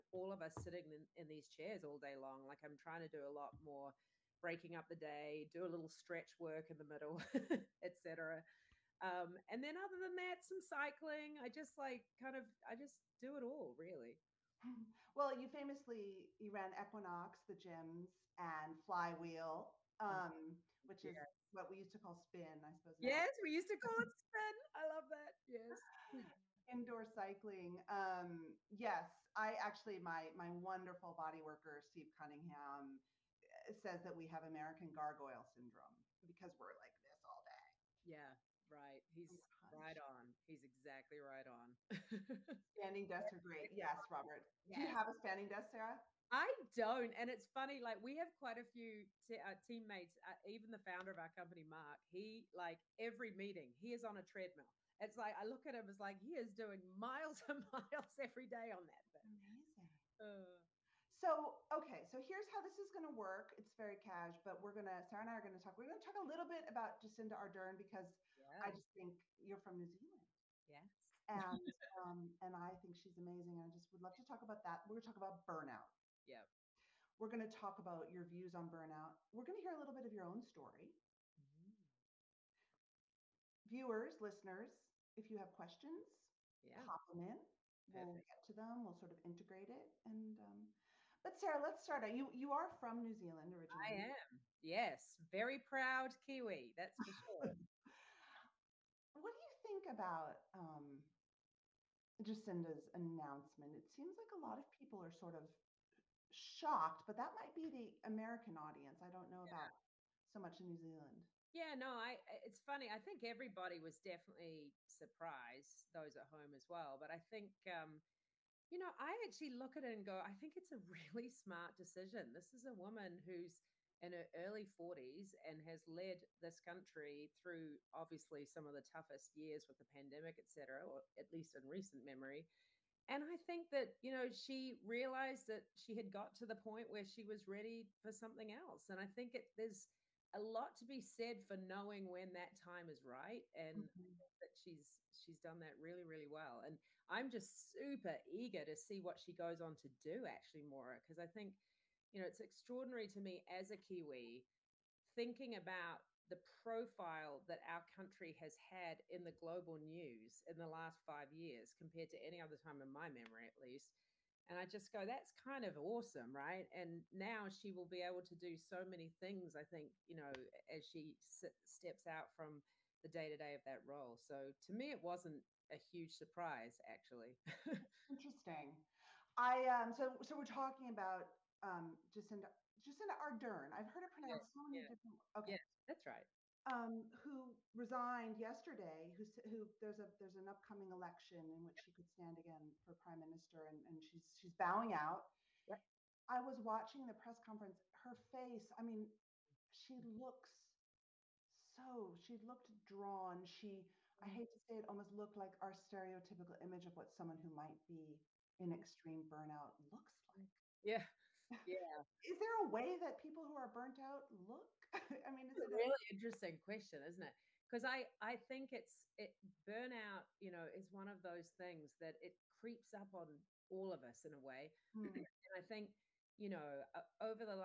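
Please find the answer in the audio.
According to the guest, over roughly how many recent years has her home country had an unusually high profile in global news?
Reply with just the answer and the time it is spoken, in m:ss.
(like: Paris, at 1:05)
5 years, at 2:41.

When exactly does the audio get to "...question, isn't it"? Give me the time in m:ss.
3:36.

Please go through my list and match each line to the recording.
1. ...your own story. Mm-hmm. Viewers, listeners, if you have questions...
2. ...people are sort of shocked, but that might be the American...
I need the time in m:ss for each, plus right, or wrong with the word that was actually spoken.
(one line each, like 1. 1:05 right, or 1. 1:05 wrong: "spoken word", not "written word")
1. 1:20 right
2. 1:44 right.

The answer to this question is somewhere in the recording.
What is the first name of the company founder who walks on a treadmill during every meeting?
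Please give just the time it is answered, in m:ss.
0:51.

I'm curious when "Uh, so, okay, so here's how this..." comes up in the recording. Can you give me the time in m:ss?
1:00.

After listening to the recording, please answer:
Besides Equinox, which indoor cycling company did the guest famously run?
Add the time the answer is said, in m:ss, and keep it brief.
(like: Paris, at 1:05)
Flywheel, at 0:18.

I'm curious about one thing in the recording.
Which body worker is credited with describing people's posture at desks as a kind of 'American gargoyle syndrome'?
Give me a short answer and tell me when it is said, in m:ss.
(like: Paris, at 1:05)
Steve Cunningham, at 0:31.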